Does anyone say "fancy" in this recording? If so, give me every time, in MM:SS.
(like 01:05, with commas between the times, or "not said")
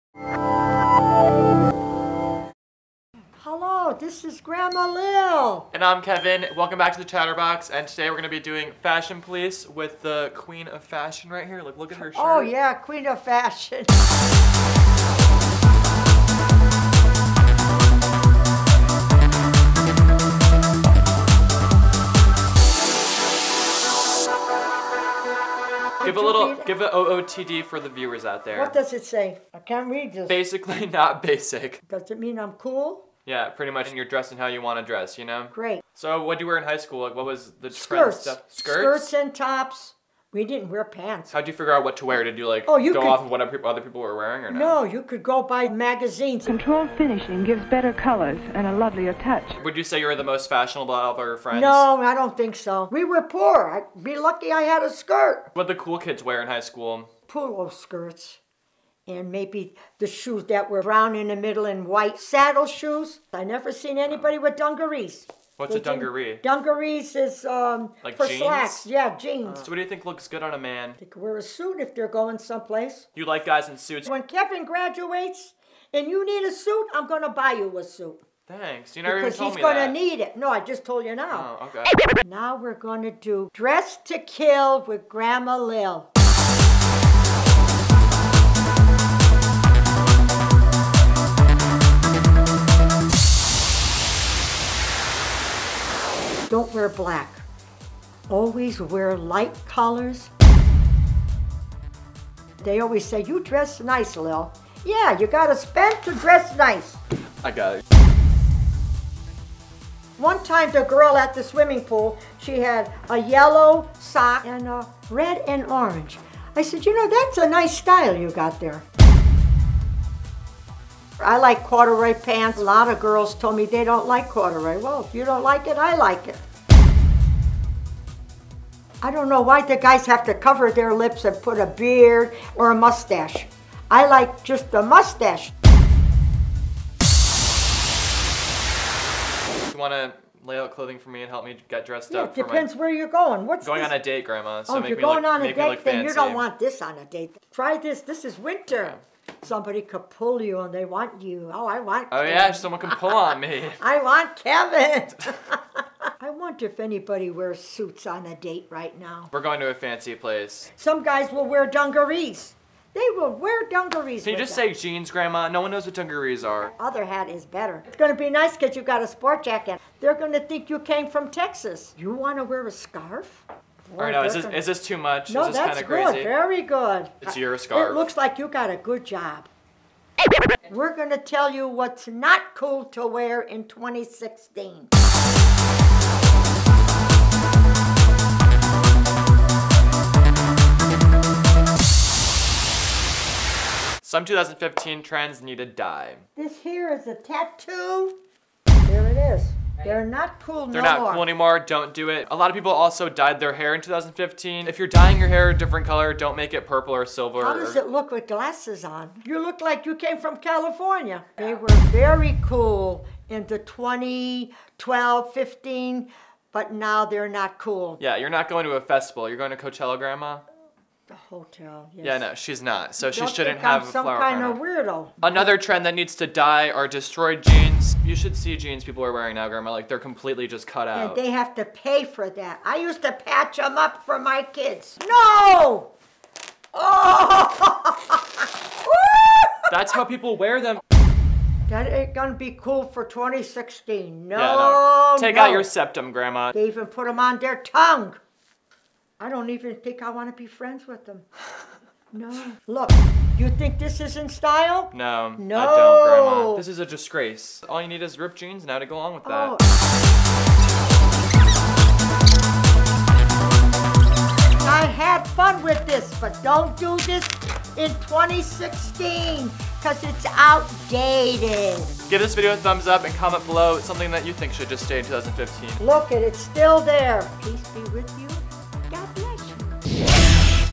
02:39.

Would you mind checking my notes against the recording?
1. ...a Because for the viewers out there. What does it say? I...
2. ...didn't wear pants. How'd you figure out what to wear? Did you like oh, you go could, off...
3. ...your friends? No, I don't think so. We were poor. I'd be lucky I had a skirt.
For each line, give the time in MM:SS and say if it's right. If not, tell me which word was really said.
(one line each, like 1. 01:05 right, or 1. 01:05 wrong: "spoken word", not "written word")
1. 00:26 wrong: "OOTD", not "Because"
2. 00:40 right
3. 00:51 right.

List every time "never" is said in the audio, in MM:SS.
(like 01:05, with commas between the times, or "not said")
01:03, 01:19.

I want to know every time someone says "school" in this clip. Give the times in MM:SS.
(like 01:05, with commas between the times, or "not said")
00:36, 00:56.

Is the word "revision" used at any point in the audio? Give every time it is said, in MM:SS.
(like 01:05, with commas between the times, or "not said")
not said.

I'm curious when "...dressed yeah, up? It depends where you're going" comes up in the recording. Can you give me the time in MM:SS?
02:21.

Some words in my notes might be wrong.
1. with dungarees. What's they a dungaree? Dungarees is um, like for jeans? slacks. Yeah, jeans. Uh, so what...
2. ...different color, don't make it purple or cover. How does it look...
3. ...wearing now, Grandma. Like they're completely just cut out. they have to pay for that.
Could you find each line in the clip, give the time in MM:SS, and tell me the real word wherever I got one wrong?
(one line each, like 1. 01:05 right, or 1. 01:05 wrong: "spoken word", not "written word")
1. 01:04 right
2. 03:25 wrong: "silver", not "cover"
3. 03:49 right.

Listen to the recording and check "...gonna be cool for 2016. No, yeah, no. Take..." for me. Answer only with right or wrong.
right.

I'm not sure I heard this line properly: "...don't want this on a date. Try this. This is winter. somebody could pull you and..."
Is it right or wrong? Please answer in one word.
right.